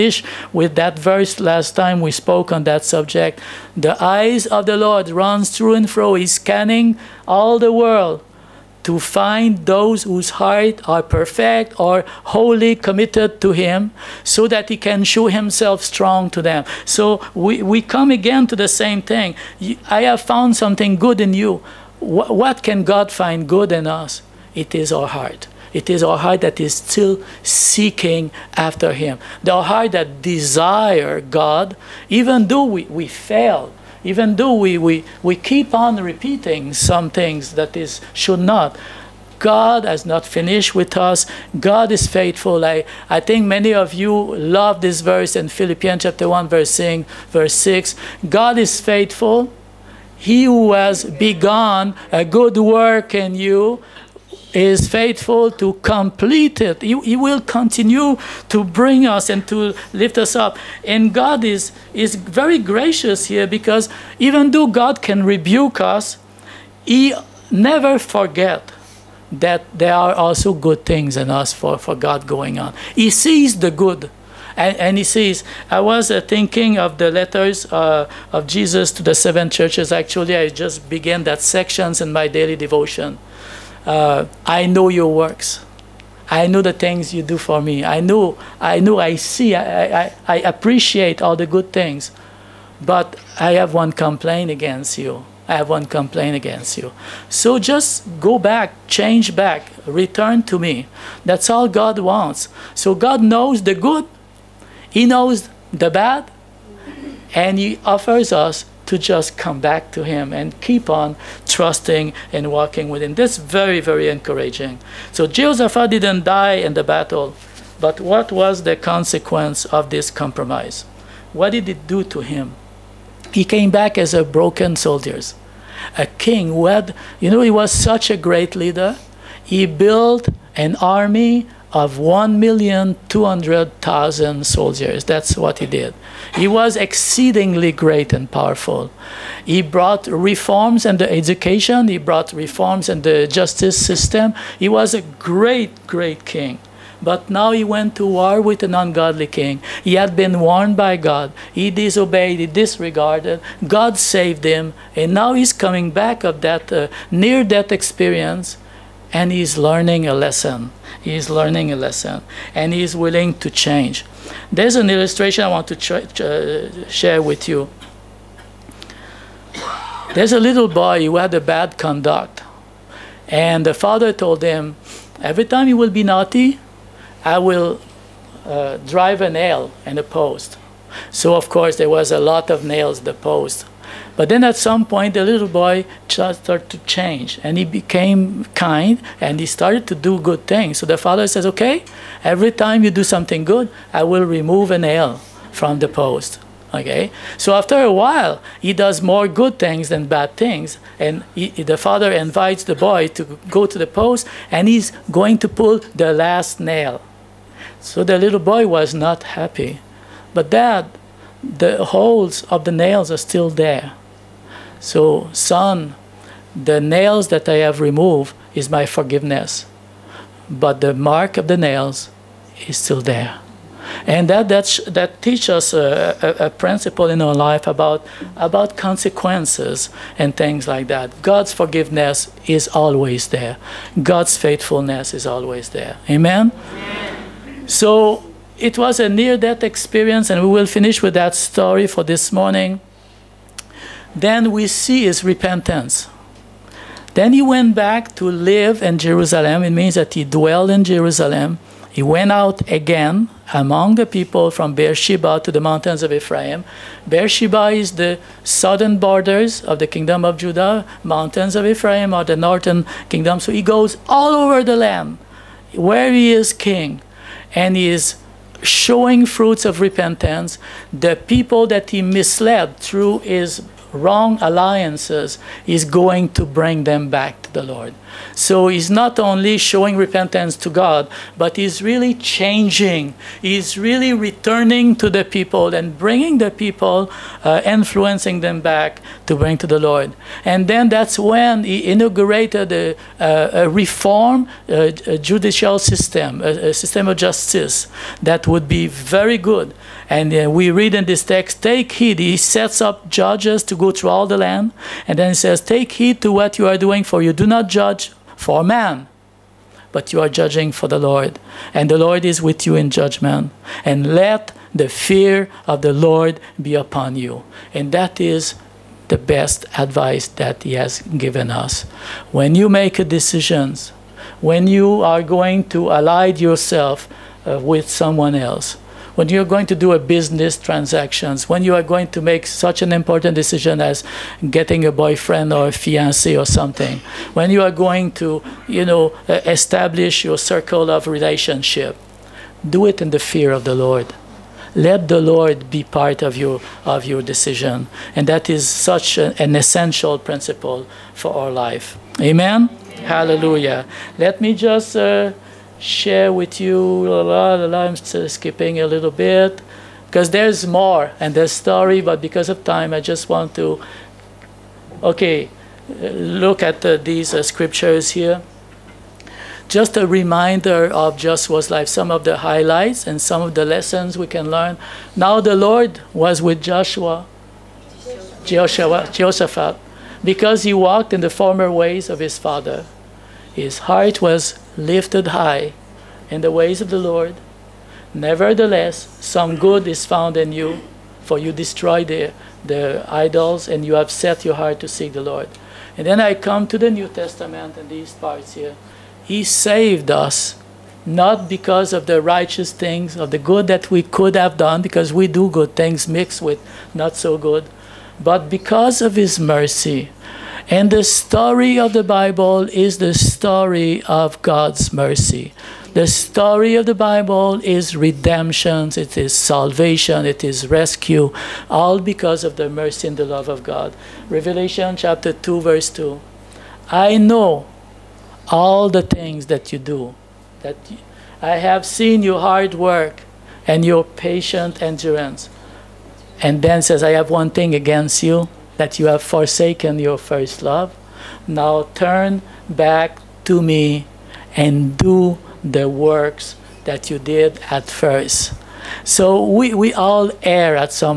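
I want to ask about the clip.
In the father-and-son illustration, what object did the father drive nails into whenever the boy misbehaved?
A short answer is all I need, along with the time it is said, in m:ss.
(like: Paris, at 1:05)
A post, at 2:59.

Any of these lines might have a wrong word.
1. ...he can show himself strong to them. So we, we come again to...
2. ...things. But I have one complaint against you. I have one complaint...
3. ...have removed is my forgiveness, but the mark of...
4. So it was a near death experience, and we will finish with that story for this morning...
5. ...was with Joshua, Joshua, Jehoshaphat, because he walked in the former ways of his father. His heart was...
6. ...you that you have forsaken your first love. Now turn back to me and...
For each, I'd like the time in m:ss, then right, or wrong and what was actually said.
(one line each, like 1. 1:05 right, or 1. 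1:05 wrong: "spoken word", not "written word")
1. 0:14 right
2. 1:31 right
3. 3:37 right
4. 3:57 right
5. 6:16 right
6. 7:18 right.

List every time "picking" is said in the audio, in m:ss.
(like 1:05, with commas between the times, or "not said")
not said.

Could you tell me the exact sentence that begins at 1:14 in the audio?
And, and he says, I was uh, thinking of the letters uh, of Jesus to the seven churches.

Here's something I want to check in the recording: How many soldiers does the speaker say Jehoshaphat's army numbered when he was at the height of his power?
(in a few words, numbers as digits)
1,200,000.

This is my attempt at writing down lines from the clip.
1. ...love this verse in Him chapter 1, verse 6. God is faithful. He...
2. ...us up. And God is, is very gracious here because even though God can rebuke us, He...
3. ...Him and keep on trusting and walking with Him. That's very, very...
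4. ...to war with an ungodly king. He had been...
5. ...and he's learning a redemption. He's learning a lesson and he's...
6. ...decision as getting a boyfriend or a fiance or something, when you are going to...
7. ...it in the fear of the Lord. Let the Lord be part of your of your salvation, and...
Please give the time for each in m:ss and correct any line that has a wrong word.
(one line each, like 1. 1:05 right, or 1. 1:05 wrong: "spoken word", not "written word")
1. 0:44 wrong: "Philippians", not "Him"
2. 1:00 right
3. 1:50 right
4. 2:27 right
5. 2:39 wrong: "lesson", not "redemption"
6. 5:33 right
7. 5:42 wrong: "decision", not "salvation".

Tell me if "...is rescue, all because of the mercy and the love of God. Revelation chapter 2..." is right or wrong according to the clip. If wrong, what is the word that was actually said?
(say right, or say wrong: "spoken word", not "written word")
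right.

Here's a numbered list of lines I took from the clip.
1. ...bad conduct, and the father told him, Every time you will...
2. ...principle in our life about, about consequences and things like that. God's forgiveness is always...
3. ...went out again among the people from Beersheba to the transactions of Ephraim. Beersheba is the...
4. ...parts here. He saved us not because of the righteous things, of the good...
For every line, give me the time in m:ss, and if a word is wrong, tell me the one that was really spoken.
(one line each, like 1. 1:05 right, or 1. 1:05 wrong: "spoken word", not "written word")
1. 2:51 right
2. 3:46 right
3. 4:12 wrong: "mountains", not "transactions"
4. 6:38 right.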